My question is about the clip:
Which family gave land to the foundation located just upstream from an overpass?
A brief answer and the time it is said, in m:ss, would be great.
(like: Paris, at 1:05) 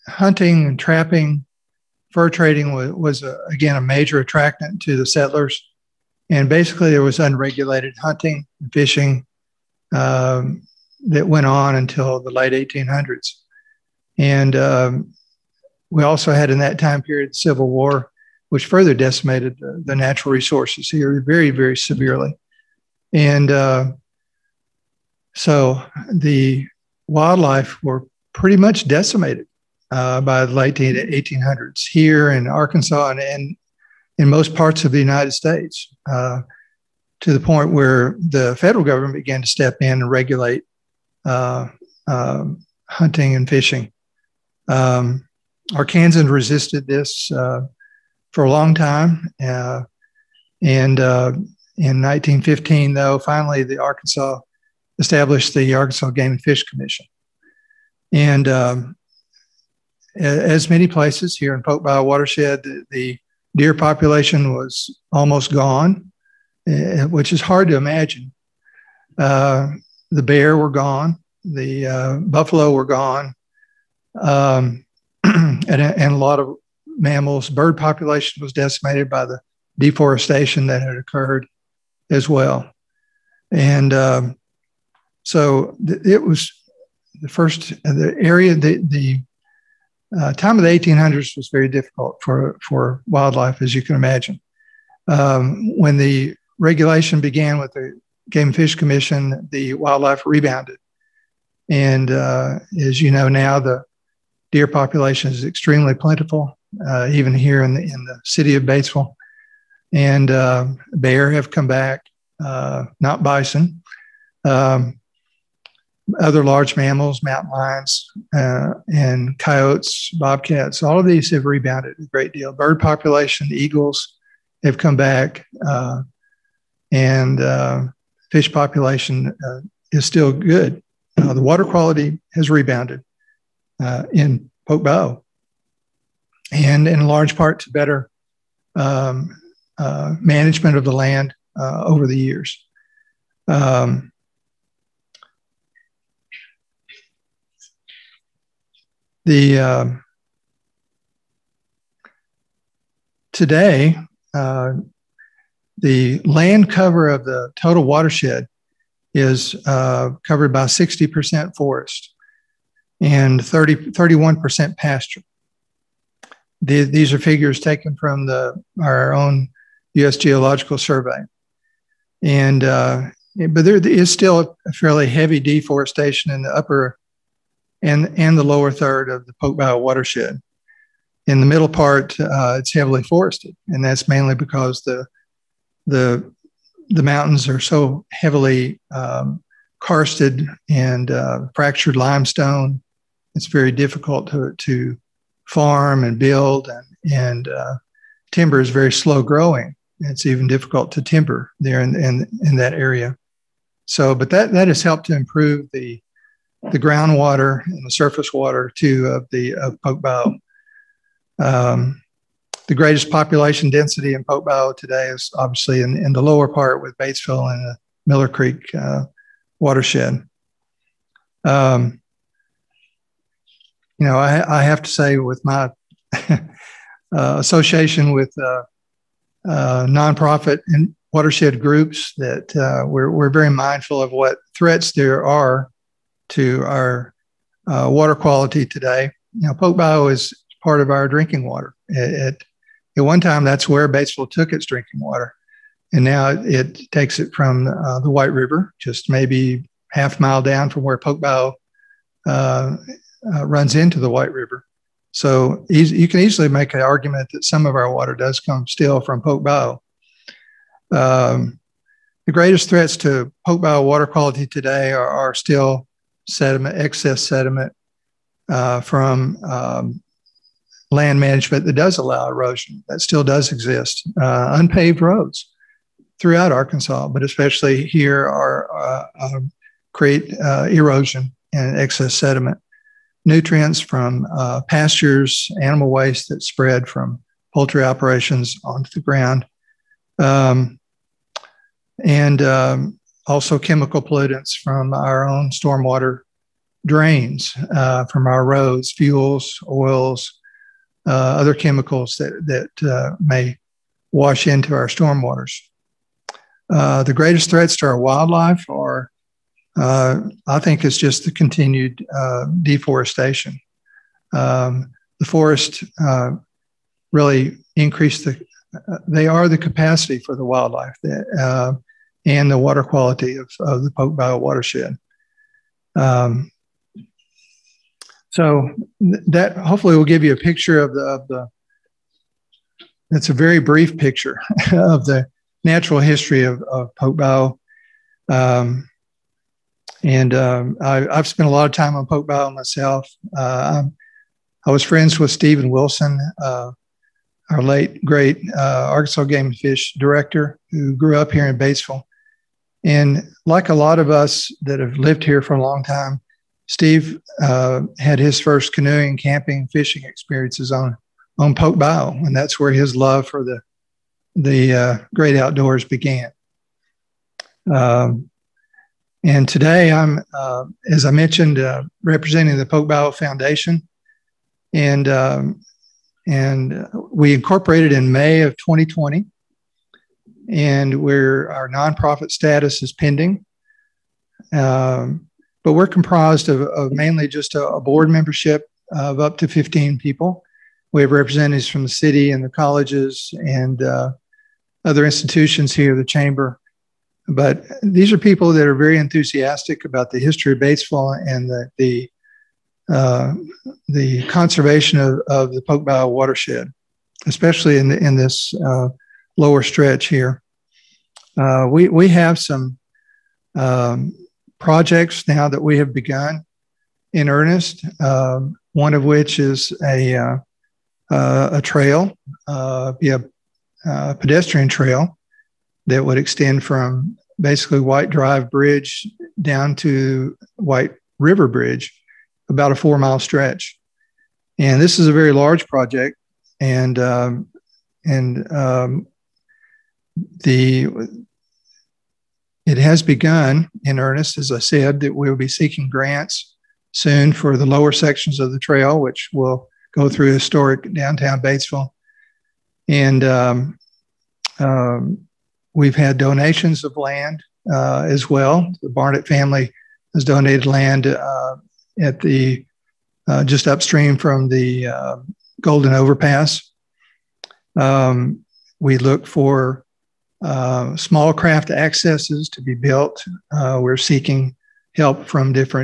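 The Barnett family, at 7:38.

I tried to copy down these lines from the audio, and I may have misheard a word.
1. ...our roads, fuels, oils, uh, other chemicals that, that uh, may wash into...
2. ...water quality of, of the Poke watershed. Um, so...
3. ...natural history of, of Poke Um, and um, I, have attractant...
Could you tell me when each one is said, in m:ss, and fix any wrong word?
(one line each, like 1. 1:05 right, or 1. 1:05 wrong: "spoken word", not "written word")
1. 4:58 right
2. 5:22 right
3. 5:35 wrong: "spent", not "attractant".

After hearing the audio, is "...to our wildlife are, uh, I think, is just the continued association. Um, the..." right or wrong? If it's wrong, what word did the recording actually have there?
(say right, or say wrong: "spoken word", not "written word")
wrong: "deforestation", not "association".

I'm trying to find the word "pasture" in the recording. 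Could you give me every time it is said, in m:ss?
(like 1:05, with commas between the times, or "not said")
2:44, 4:44.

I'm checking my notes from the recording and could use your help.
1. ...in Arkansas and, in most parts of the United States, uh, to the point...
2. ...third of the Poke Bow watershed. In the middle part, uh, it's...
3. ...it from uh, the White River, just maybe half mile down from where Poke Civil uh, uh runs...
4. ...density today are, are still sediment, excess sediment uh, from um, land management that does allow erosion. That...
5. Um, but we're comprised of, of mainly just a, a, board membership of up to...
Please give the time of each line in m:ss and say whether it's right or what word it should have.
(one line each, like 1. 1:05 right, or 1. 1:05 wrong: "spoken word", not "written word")
1. 0:32 right
2. 2:58 right
3. 4:07 wrong: "Bayou", not "Civil"
4. 4:24 wrong: "quality", not "density"
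5. 6:24 right.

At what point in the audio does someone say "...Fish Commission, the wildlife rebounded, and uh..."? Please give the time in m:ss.
1:38.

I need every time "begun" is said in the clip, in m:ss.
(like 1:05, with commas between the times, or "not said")
6:55, 7:23.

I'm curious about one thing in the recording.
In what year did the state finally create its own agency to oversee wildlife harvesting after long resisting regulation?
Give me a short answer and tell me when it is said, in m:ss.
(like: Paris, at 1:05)
1915, at 0:52.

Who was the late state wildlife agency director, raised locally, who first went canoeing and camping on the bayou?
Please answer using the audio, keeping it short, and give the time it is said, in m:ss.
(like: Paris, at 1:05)
Stephen Wilson, at 5:45.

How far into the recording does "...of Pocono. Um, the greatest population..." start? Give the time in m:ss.
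3:29.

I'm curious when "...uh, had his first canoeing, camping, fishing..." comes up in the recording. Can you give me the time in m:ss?
5:57.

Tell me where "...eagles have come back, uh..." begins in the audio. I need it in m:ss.
2:03.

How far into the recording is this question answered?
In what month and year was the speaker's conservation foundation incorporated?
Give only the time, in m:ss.
6:18.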